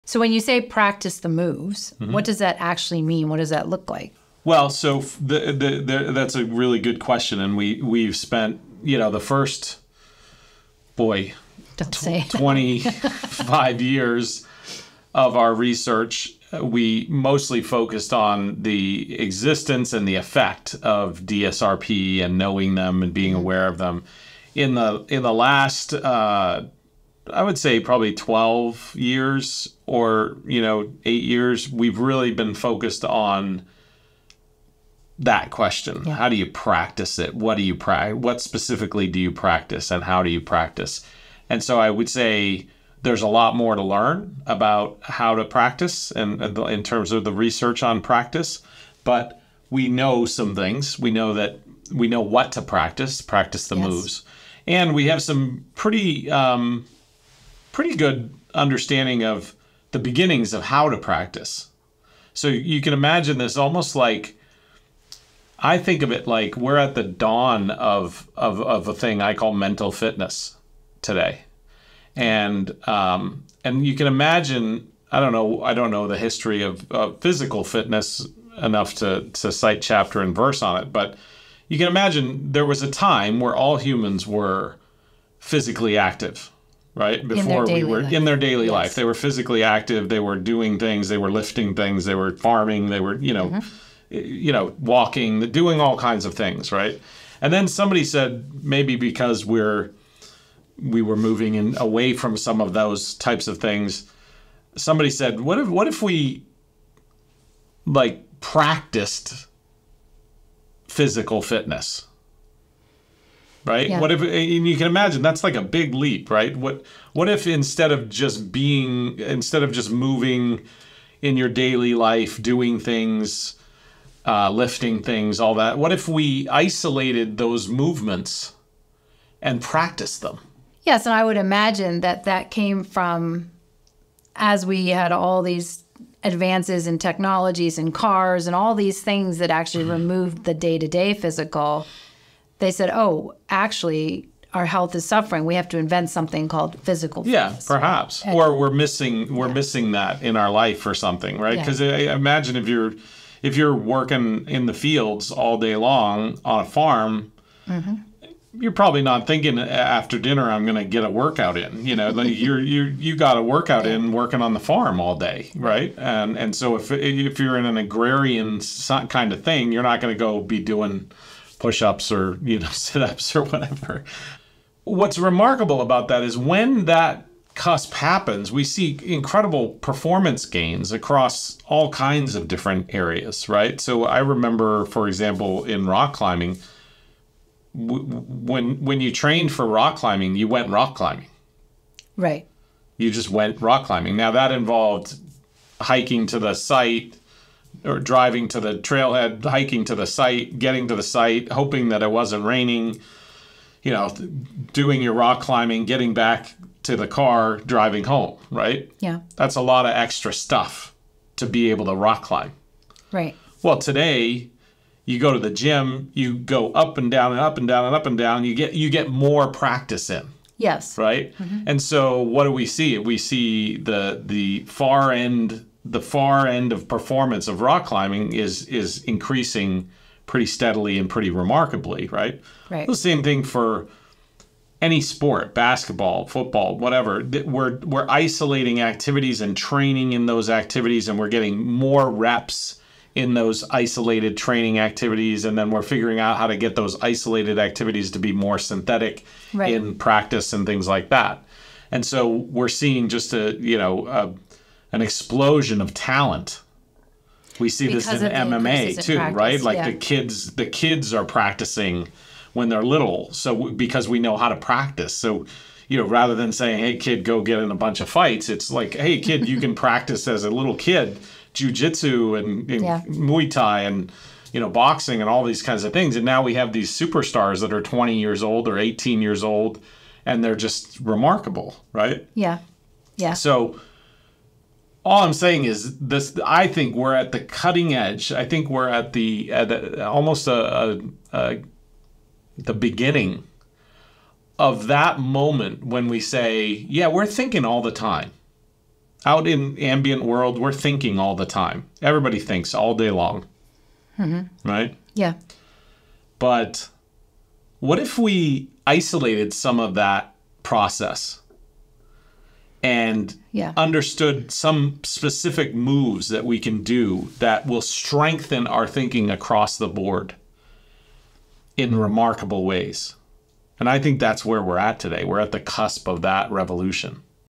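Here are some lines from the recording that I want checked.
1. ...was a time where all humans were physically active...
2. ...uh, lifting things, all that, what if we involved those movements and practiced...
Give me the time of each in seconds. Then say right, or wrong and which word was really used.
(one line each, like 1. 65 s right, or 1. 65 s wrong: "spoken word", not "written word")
1. 82 s right
2. 124 s wrong: "isolated", not "involved".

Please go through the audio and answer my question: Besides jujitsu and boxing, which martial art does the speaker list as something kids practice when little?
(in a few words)
Muay Thai.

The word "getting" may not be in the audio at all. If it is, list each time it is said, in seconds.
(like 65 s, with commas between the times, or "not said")
200 s, 205 s, 241 s.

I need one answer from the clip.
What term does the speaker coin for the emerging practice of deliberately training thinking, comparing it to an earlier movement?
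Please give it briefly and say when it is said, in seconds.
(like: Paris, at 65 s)
mental fitness, at 69 s.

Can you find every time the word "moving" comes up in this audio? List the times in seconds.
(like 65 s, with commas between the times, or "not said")
101 s, 119 s.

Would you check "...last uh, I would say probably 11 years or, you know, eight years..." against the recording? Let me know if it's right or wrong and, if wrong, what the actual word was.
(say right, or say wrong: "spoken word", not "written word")
wrong: "12", not "11".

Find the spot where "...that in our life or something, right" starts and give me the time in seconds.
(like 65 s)
149 s.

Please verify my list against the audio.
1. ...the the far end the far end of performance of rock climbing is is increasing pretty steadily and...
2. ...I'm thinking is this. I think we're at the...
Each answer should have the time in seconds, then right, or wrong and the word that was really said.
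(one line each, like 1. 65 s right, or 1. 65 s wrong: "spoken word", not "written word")
1. 223 s right
2. 285 s wrong: "saying", not "thinking".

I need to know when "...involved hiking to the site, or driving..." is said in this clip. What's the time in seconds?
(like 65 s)
194 s.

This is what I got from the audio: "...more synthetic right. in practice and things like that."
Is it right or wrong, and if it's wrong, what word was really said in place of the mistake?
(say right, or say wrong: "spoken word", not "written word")
right.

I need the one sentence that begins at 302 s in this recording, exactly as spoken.
Everybody thinks all day long, mm-hmm.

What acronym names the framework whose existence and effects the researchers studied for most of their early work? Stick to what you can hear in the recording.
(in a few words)
DSRP.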